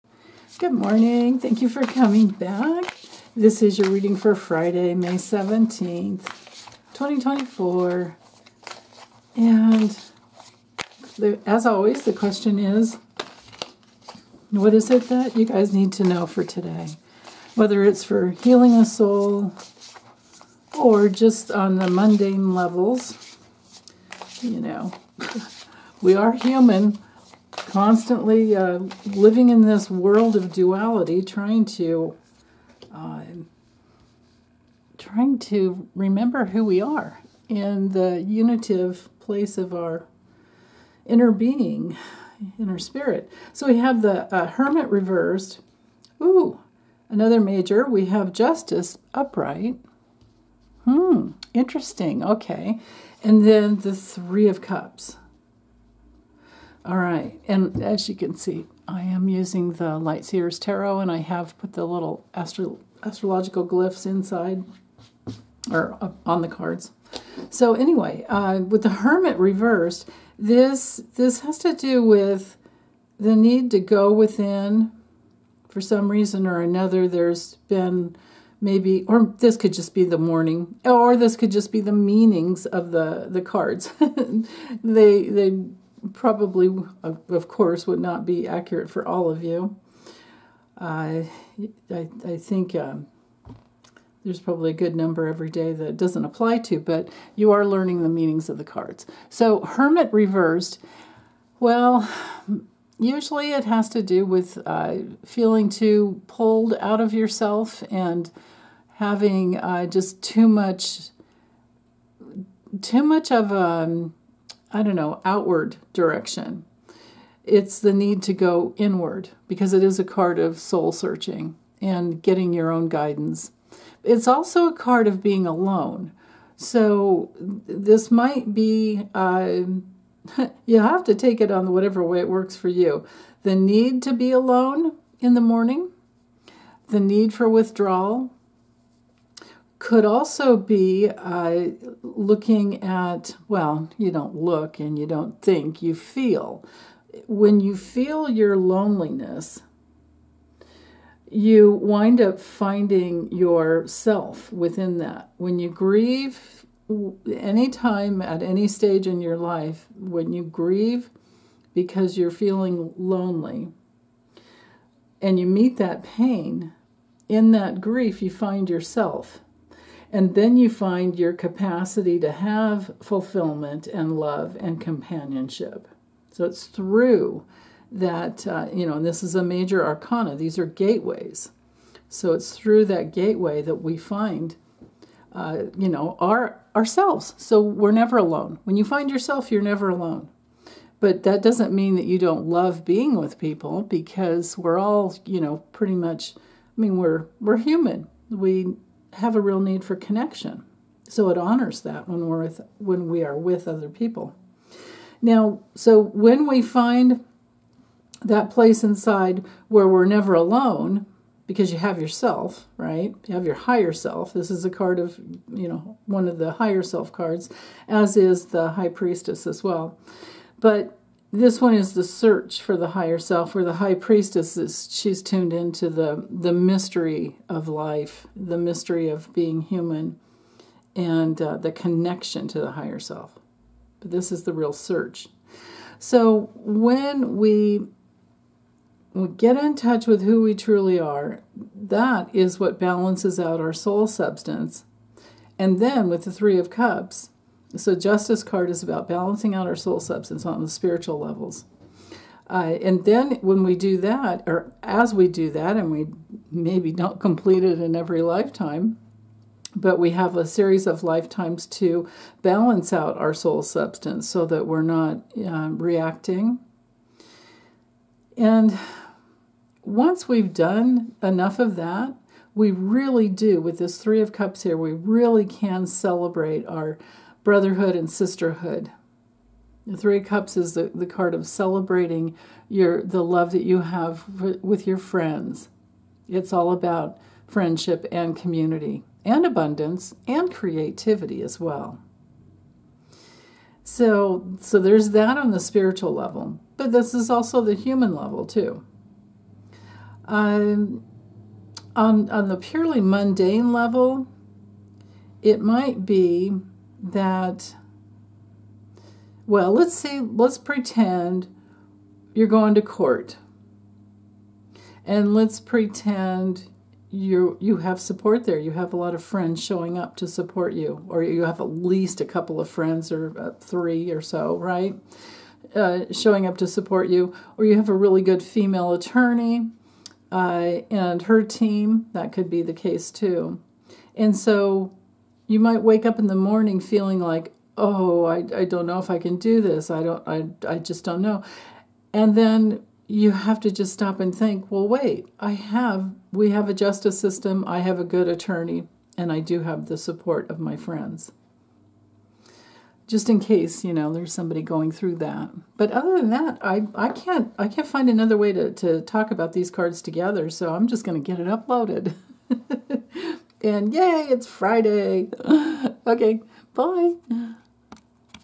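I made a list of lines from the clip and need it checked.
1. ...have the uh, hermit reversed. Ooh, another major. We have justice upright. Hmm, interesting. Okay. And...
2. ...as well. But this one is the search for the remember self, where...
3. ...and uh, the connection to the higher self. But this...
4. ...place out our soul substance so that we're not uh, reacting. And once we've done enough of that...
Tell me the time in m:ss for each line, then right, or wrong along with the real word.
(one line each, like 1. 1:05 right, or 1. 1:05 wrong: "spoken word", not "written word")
1. 0:43 right
2. 3:39 wrong: "higher", not "remember"
3. 3:50 right
4. 4:22 wrong: "balance", not "place".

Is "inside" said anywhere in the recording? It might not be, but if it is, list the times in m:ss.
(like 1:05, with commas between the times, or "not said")
1:04, 3:28.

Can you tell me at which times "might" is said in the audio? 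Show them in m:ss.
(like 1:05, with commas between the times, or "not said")
2:08, 5:05, 5:35.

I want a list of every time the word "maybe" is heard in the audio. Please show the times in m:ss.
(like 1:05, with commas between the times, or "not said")
1:18, 4:16.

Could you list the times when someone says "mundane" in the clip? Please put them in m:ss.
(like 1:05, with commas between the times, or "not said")
0:21, 5:03.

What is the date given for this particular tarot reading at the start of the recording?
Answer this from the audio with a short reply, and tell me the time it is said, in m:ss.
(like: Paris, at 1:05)
Friday, May 17th, 2024, at 0:04.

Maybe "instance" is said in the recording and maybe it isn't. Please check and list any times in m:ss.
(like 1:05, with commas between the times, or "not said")
not said.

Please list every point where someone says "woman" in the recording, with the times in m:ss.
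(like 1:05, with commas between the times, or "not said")
not said.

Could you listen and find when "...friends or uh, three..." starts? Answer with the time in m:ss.
5:22.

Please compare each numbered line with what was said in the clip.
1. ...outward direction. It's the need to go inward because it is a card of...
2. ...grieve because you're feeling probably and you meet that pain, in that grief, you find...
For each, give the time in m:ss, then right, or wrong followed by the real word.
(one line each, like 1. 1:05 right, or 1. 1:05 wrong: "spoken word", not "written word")
1. 1:55 right
2. 2:40 wrong: "lonely", not "probably".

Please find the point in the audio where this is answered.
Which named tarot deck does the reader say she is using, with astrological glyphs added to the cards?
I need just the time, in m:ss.
0:59.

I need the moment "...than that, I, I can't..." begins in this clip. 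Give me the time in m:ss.
5:56.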